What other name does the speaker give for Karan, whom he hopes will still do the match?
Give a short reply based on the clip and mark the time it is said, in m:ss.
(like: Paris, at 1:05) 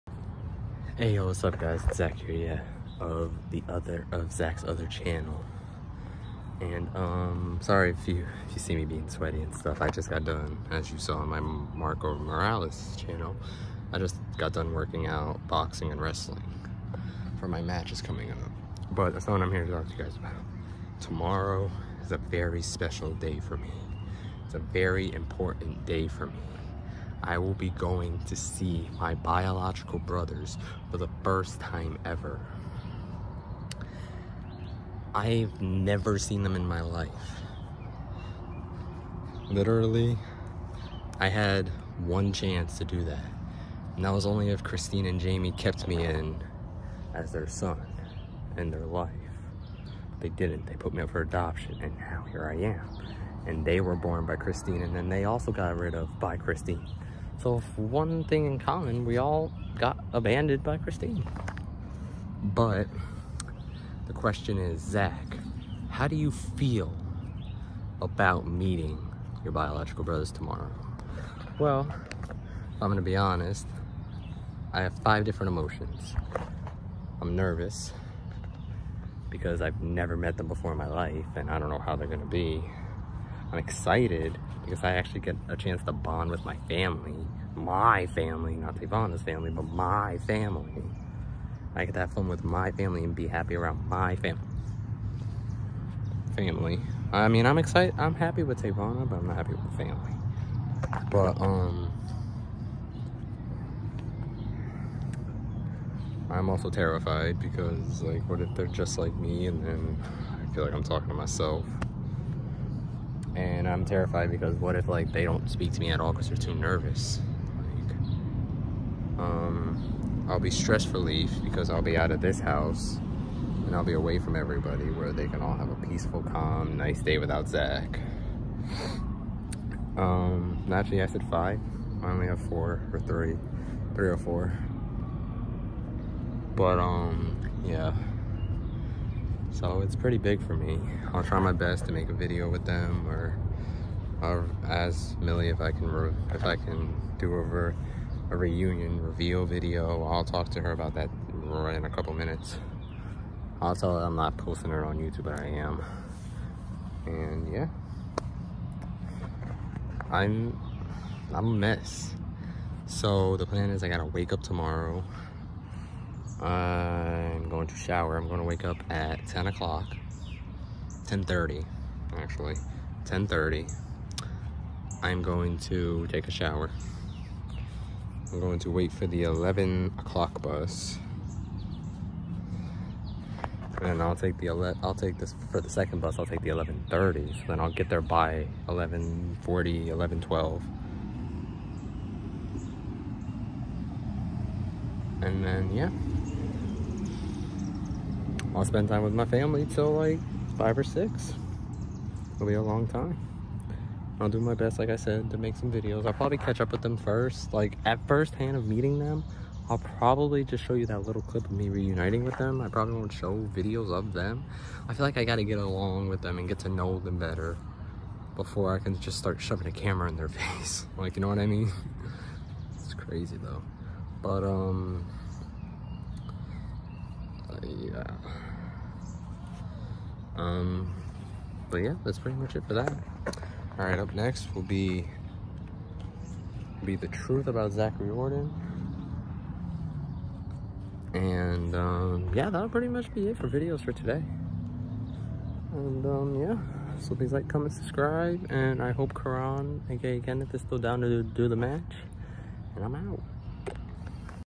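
Kenneth, at 4:10.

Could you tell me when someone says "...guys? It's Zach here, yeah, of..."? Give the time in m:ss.
0:01.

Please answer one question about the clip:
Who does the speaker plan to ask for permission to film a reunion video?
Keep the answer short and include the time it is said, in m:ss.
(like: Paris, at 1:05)
Millie, at 2:25.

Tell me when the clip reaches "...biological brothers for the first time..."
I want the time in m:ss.
0:29.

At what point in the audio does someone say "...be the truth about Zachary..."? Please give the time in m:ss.
3:56.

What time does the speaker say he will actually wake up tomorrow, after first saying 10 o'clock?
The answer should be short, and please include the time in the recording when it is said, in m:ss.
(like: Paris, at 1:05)
10:30, at 2:51.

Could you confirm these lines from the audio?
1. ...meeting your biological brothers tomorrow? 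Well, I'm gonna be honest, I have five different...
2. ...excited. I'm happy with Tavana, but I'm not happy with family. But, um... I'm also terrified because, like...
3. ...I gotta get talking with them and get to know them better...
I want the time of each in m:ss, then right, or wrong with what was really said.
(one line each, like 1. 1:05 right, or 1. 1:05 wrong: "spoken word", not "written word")
1. 1:08 right
2. 1:37 right
3. 3:35 wrong: "along", not "talking".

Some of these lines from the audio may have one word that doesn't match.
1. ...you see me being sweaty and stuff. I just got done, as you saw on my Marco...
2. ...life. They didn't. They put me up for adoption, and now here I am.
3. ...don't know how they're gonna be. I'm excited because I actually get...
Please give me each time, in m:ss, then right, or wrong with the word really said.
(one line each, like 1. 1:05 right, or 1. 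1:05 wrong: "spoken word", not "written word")
1. 0:08 right
2. 0:48 right
3. 1:21 right.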